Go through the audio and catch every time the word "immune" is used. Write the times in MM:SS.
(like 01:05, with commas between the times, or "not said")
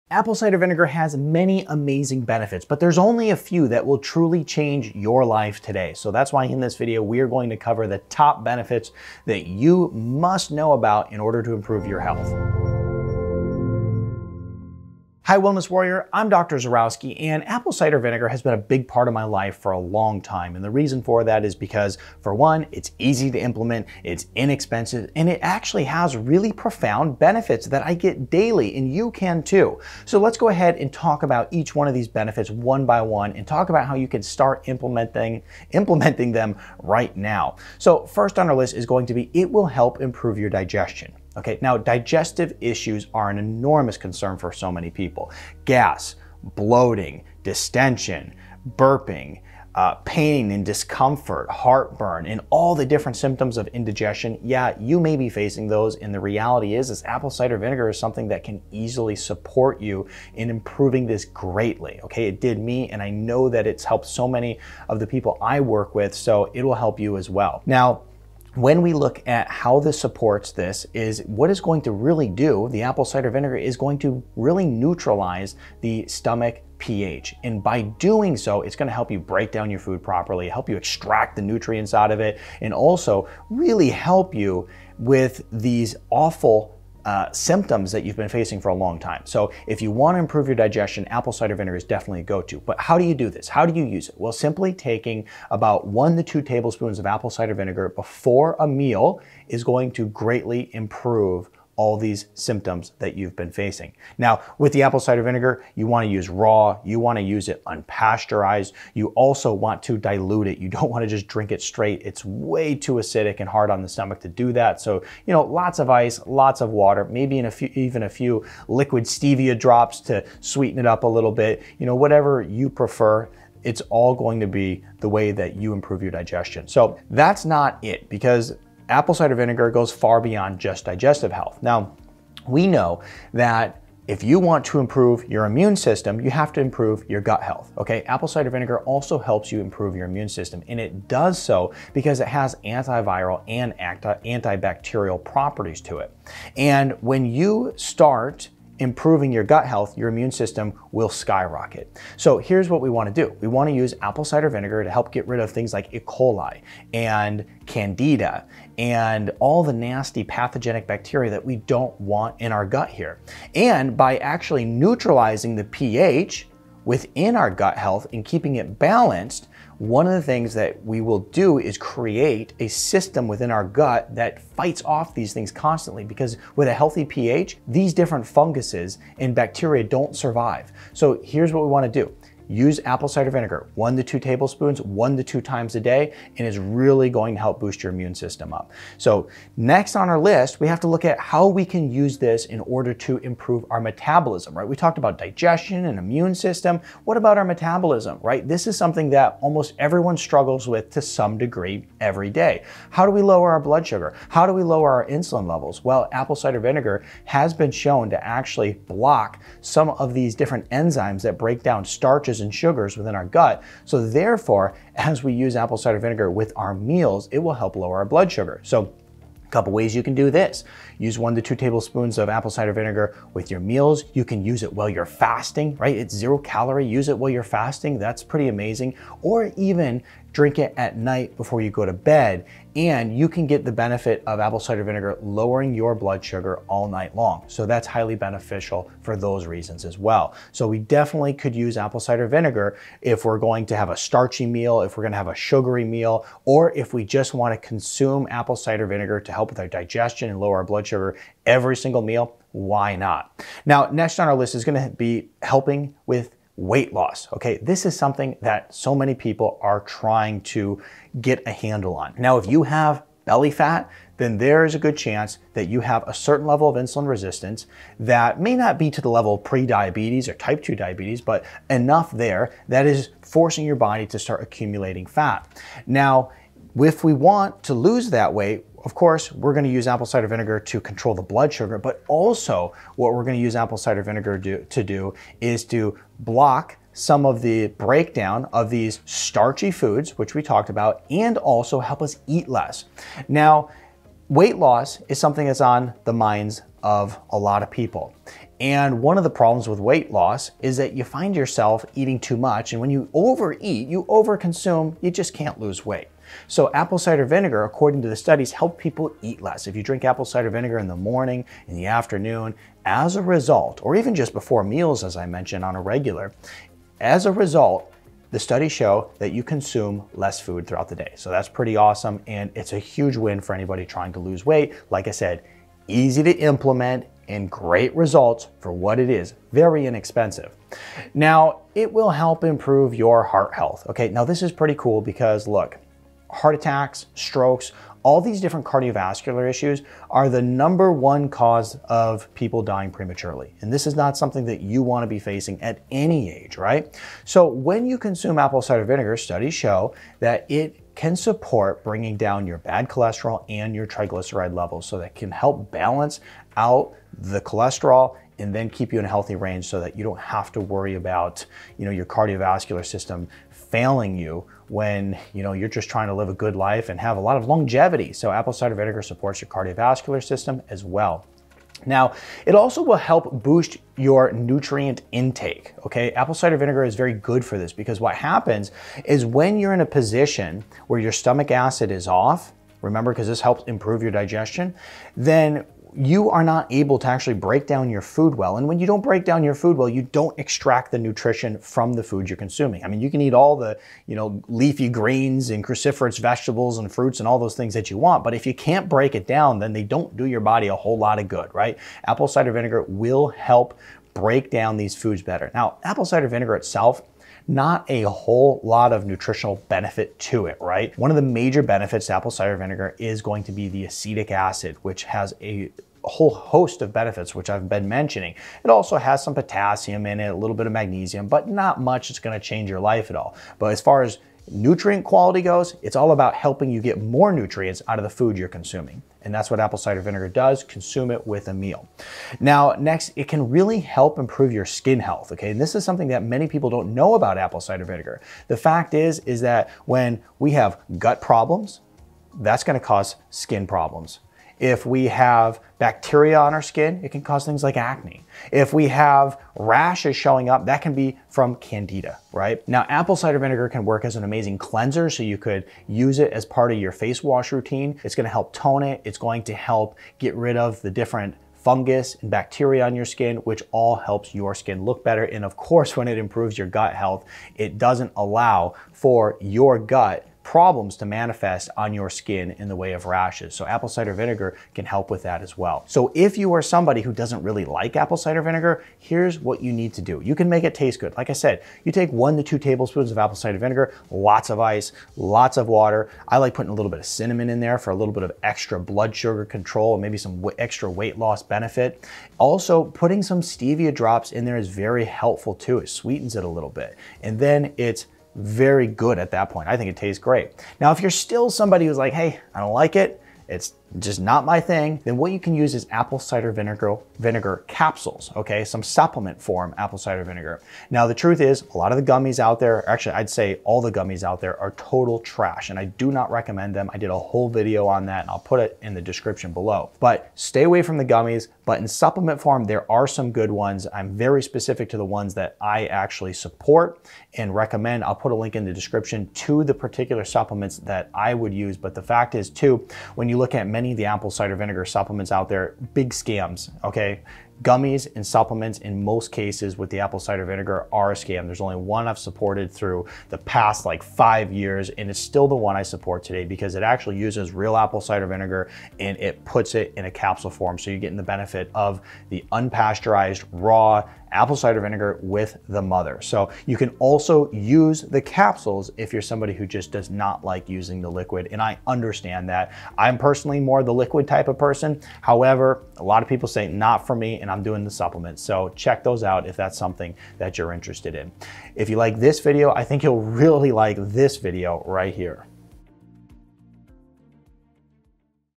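02:15, 02:20, 02:30, 03:07, 03:15.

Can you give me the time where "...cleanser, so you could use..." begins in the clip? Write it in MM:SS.
07:34.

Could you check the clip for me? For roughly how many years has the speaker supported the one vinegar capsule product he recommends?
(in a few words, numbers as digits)
5.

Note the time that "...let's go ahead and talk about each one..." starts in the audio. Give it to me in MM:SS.
00:30.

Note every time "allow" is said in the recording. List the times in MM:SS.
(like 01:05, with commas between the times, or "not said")
07:48.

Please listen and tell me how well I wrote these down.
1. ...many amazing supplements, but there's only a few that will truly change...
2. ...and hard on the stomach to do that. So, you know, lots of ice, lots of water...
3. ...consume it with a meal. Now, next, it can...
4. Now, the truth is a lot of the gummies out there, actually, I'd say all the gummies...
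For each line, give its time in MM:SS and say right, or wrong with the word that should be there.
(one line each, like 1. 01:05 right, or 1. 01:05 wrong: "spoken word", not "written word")
1. 00:01 wrong: "benefits", not "supplements"
2. 01:53 right
3. 07:10 right
4. 08:30 right.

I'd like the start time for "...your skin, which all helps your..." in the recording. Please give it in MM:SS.
07:42.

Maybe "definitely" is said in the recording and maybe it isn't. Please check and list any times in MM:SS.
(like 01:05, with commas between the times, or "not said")
01:31, 04:00.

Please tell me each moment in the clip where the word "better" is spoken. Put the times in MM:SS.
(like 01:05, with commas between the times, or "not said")
06:45, 07:45.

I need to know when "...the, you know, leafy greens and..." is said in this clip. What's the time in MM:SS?
06:33.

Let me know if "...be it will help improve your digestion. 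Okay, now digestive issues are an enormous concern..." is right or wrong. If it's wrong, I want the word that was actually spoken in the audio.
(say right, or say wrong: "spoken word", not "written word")
right.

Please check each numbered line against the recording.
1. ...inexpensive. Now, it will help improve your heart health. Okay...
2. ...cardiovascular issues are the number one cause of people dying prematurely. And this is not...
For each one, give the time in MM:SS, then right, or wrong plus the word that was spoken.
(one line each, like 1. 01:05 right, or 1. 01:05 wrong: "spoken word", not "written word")
1. 05:29 right
2. 05:38 right.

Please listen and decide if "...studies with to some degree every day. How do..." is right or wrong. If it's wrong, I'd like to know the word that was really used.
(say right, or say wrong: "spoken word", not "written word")
wrong: "struggles", not "studies".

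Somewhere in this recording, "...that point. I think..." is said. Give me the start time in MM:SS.
08:19.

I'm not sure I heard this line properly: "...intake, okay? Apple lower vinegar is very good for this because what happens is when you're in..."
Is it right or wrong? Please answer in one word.
wrong.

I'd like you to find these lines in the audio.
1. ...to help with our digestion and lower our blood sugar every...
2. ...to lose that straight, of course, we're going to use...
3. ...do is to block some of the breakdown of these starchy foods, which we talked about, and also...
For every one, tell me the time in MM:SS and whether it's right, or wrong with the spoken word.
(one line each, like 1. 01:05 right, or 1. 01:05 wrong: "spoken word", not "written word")
1. 04:09 right
2. 04:37 wrong: "weight", not "straight"
3. 04:44 right.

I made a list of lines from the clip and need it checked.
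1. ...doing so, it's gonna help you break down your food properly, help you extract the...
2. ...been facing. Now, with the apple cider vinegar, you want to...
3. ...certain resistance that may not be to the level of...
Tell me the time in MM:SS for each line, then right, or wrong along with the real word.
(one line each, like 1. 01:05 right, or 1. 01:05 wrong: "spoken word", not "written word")
1. 01:17 right
2. 01:43 right
3. 04:26 wrong: "insulin", not "certain".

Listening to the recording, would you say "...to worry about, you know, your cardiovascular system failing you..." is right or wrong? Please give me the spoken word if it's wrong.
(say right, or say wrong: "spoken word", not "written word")
right.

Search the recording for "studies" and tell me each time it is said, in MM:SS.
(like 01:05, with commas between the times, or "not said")
05:08, 05:18, 05:49.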